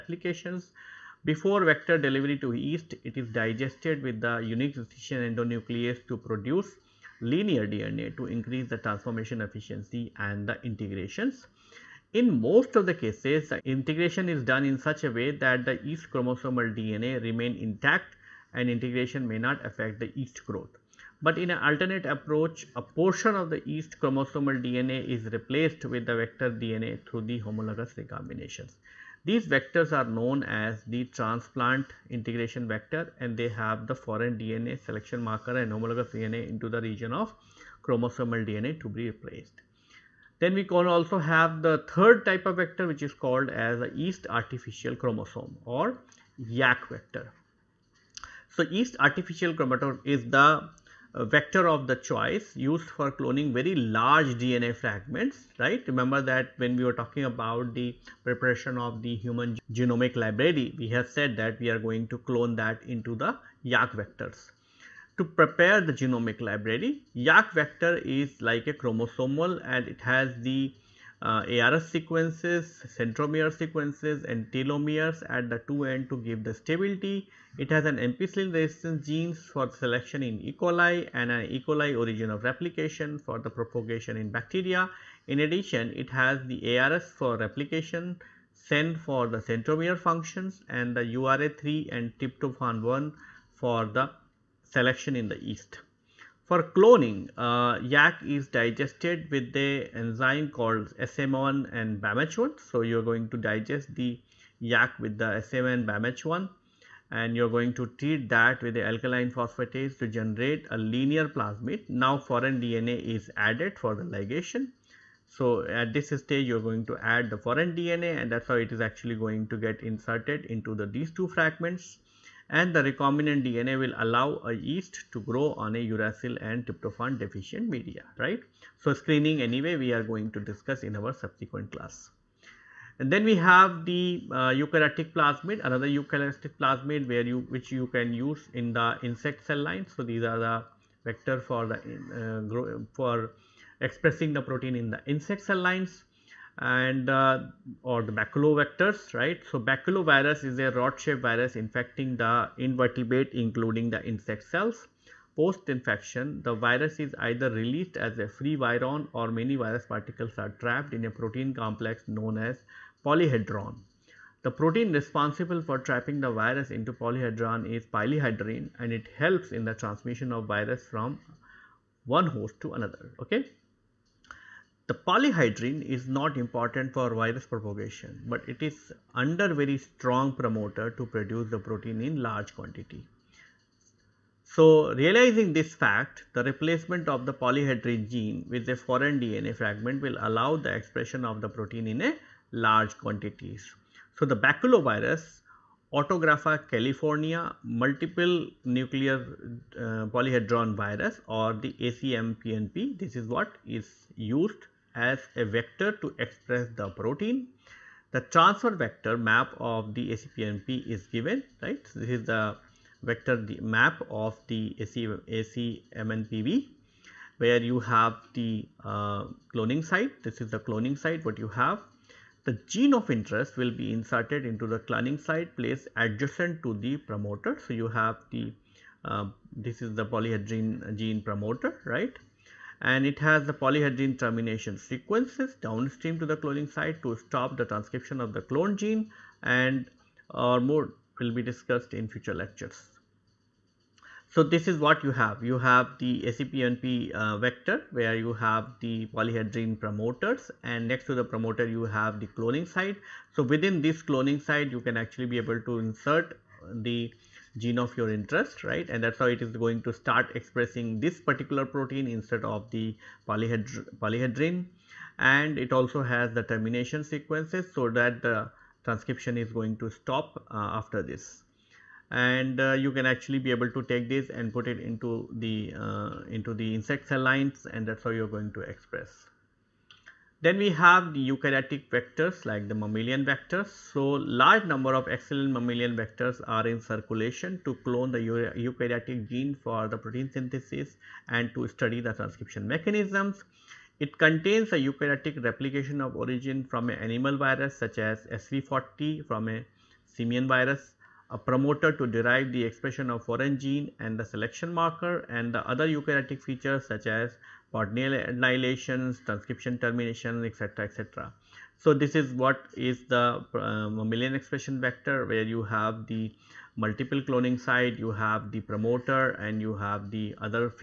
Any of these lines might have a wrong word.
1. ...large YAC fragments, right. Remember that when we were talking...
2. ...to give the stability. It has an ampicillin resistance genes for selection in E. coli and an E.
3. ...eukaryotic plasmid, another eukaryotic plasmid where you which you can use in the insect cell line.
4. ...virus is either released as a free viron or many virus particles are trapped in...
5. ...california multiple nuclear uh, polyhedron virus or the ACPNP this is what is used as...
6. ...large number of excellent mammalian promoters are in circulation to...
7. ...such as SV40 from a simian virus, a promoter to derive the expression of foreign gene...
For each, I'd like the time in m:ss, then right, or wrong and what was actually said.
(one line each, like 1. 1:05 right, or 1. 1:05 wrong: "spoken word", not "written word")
1. 0:53 wrong: "DNA", not "YAC"
2. 1:16 right
3. 2:14 right
4. 2:36 right
5. 3:16 wrong: "ACMPNP", not "ACPNP"
6. 4:44 wrong: "vectors", not "promoters"
7. 4:57 right.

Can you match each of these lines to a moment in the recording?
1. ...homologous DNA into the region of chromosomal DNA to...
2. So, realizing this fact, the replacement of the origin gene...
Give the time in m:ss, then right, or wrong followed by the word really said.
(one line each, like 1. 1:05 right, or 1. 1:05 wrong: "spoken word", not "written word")
1. 0:35 right
2. 3:04 wrong: "polyhedrin", not "origin".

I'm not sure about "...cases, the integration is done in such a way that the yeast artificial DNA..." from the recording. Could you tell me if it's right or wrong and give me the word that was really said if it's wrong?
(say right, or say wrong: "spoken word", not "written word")
wrong: "chromosomal", not "artificial".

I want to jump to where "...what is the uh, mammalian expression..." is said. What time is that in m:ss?
5:12.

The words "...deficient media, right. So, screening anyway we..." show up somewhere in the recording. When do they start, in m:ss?
2:07.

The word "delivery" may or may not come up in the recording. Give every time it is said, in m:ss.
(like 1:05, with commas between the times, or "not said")
0:01.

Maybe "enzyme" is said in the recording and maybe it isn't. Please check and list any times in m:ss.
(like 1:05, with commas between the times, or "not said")
1:39.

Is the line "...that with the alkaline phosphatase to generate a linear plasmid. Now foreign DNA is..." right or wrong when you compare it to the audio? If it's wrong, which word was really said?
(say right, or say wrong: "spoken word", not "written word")
right.